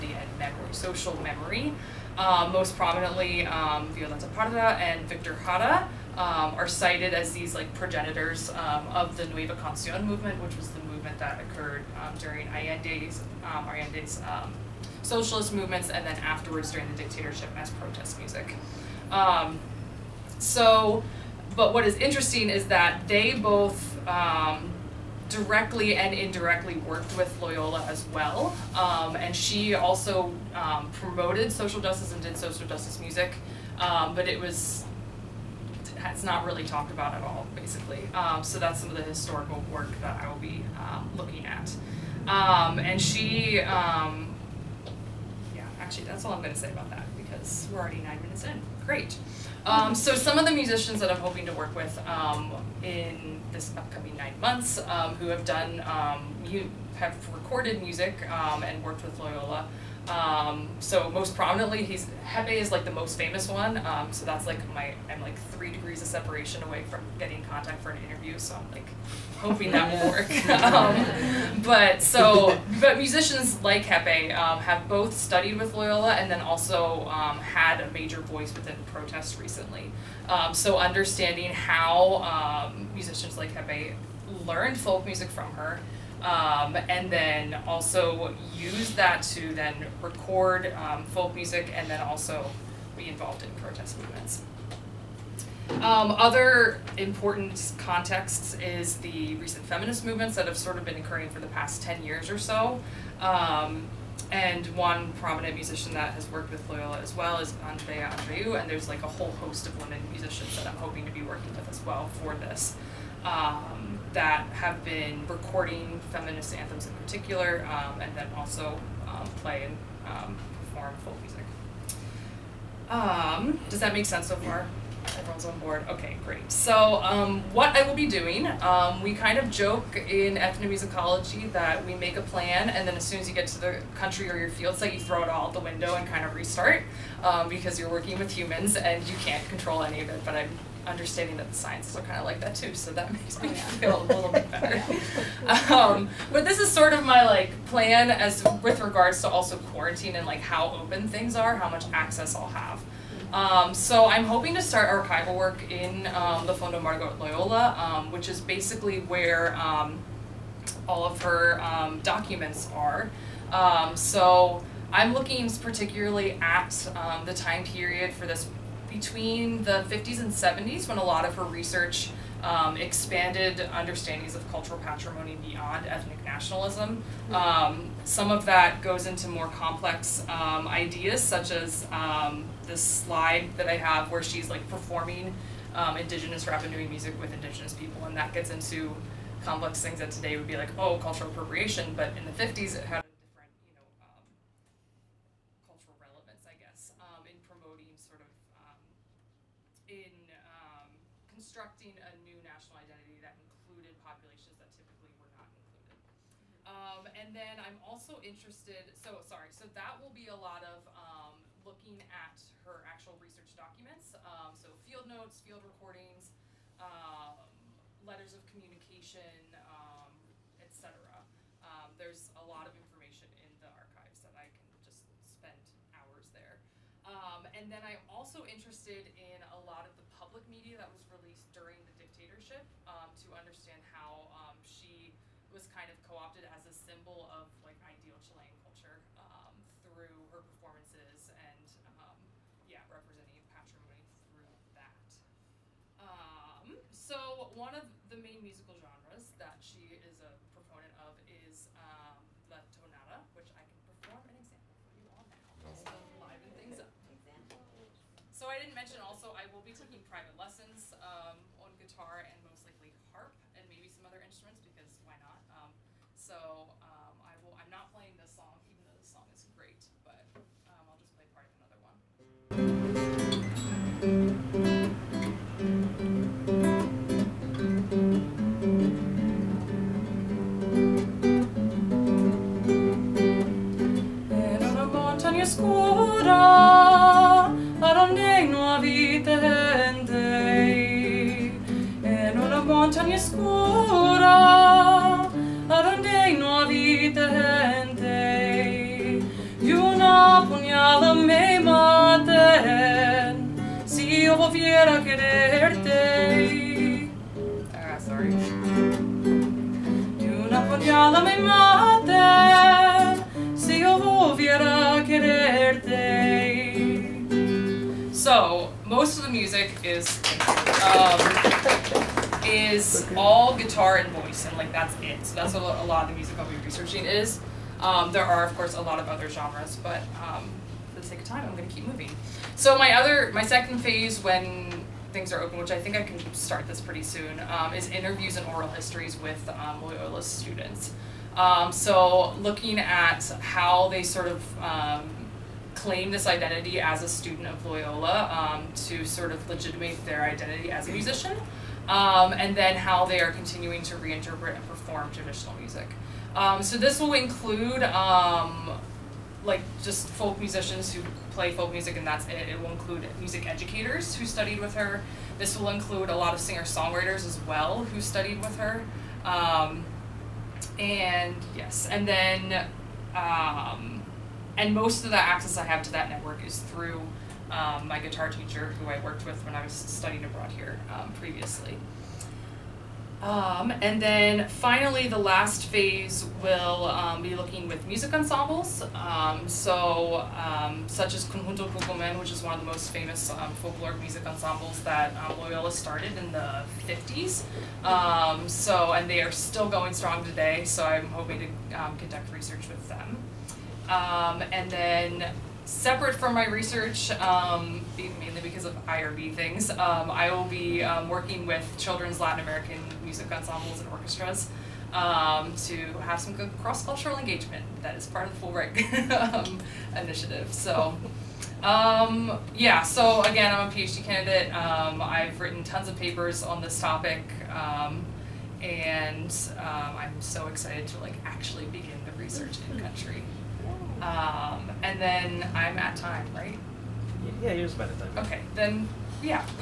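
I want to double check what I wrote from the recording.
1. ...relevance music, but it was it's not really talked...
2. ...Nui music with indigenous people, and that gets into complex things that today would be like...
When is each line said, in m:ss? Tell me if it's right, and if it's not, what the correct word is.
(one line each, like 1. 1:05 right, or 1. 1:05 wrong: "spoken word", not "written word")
1. 0:32 wrong: "justice", not "relevance"
2. 3:06 right.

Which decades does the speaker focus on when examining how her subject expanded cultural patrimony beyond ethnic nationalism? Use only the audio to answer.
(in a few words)
1950s to 1970s.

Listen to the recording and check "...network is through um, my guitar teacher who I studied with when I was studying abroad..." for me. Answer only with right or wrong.
wrong.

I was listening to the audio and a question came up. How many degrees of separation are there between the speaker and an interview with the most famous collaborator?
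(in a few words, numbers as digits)
3.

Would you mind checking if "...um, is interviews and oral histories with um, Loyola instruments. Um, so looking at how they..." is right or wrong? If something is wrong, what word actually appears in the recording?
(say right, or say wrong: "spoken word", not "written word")
wrong: "students", not "instruments".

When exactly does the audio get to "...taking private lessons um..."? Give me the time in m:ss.
4:19.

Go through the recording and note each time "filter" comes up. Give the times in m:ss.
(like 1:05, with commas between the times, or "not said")
not said.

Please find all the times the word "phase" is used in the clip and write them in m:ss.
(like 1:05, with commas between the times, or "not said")
5:33, 6:25.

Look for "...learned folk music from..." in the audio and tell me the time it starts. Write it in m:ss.
1:24.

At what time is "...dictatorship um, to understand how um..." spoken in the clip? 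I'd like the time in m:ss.
3:51.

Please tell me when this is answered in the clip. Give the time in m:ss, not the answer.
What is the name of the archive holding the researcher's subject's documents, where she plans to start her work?
2:36.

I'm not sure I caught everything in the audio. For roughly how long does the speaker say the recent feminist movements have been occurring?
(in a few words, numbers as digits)
10 years.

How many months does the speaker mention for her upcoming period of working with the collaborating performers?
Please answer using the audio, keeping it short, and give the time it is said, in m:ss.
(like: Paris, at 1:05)
9, at 0:54.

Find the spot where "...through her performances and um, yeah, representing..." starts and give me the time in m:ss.
3:59.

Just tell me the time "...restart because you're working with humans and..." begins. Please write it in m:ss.
2:16.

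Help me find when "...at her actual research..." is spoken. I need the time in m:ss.
3:32.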